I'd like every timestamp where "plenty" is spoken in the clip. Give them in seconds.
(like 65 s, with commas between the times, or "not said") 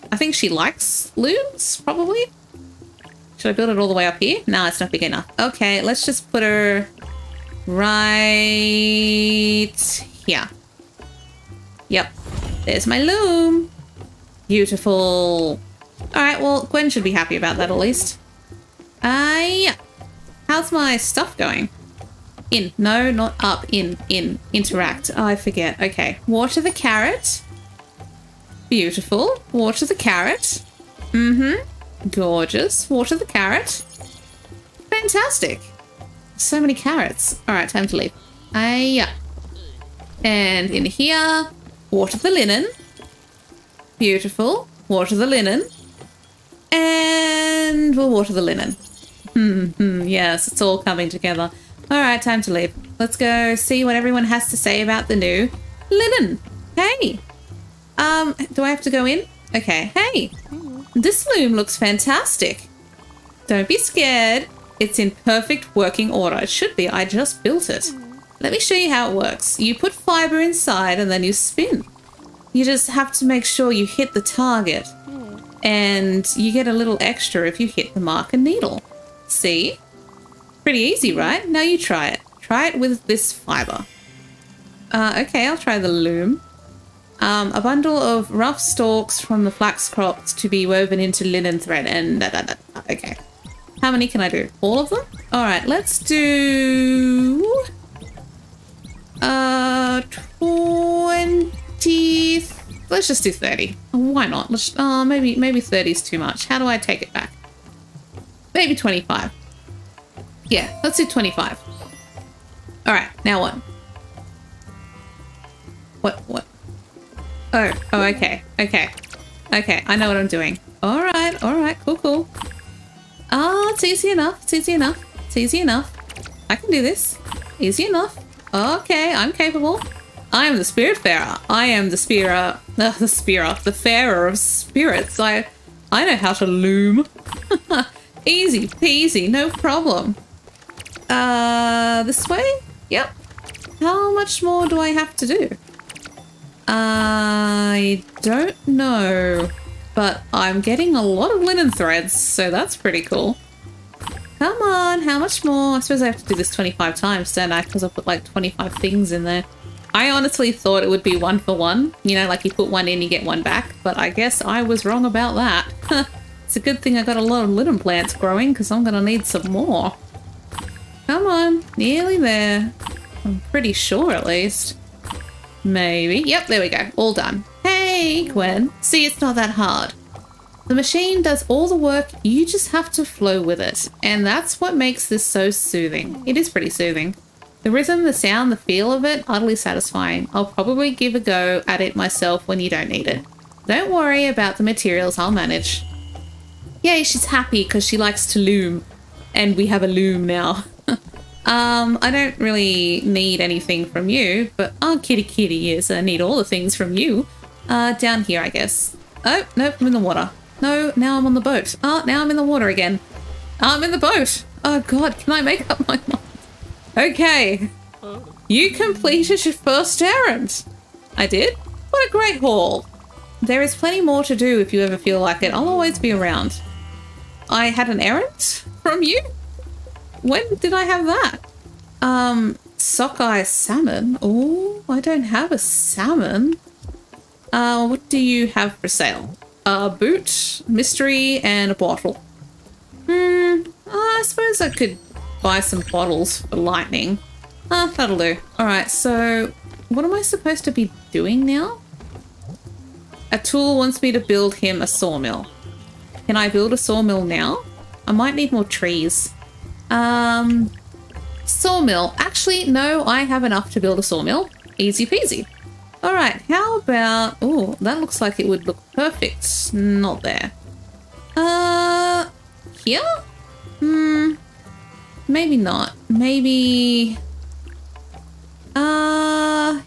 223 s.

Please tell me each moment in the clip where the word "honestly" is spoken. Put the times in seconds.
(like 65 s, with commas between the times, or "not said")
160 s.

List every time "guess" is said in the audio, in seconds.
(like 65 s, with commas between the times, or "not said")
164 s, 208 s.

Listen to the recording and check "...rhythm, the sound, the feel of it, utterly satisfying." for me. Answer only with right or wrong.
right.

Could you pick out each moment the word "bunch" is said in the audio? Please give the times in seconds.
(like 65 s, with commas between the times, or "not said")
not said.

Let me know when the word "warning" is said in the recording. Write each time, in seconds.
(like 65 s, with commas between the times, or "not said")
not said.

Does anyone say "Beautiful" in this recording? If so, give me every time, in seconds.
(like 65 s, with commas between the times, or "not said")
14 s, 28 s, 43 s.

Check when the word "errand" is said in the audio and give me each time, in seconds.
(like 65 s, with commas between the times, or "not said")
220 s, 228 s.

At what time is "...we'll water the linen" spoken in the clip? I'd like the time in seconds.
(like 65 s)
47 s.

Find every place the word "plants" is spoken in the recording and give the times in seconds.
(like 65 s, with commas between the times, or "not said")
167 s.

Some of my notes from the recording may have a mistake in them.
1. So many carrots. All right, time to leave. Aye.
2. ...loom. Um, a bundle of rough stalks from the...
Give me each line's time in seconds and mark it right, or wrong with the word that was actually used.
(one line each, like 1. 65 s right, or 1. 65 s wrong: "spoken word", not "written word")
1. 36 s right
2. 85 s right.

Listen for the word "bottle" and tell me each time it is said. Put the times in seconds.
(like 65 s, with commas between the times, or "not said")
241 s, 245 s.